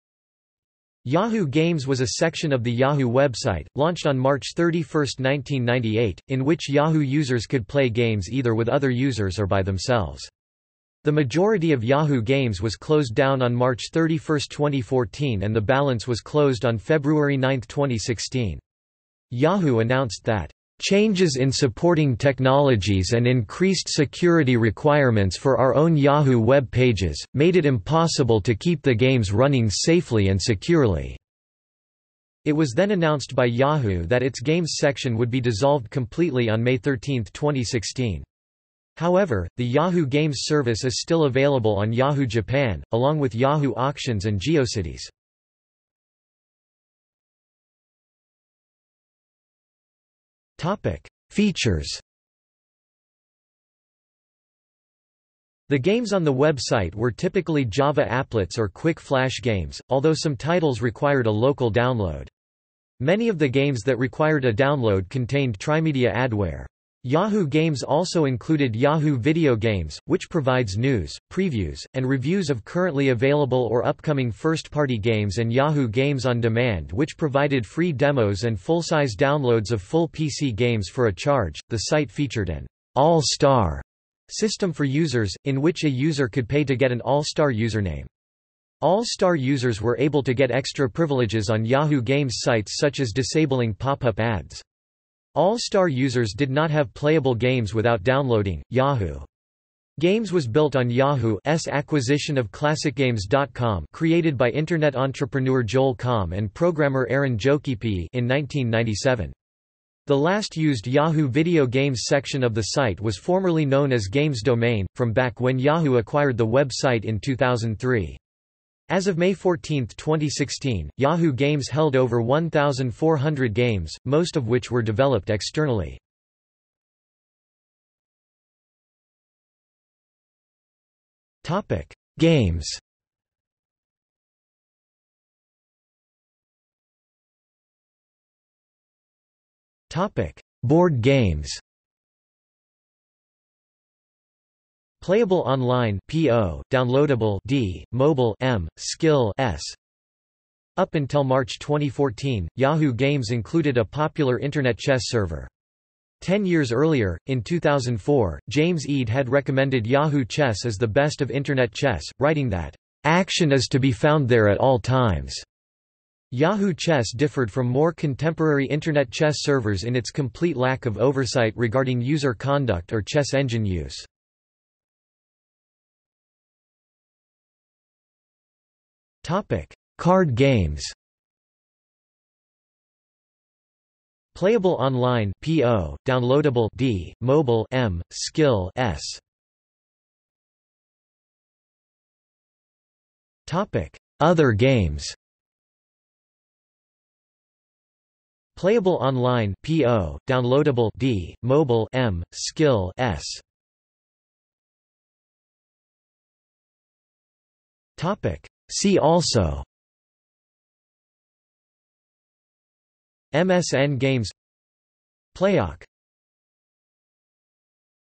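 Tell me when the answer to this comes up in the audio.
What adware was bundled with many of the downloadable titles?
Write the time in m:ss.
1:05.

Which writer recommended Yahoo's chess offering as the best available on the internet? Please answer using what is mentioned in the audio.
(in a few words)
James Eade.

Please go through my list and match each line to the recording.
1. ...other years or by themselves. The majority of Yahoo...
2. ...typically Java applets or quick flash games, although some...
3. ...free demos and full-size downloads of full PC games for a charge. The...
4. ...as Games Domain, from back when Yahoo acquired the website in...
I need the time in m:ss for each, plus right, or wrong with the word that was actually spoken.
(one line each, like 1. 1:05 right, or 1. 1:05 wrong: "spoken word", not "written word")
1. 0:08 wrong: "users", not "years"
2. 0:57 right
3. 1:17 right
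4. 1:53 right.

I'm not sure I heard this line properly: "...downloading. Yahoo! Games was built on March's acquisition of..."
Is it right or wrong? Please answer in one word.
wrong.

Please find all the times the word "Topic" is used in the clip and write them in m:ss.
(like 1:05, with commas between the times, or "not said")
0:50, 2:11, 2:19, 2:59, 3:13, 3:27.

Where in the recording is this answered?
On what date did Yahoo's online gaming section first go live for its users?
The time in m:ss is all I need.
0:04.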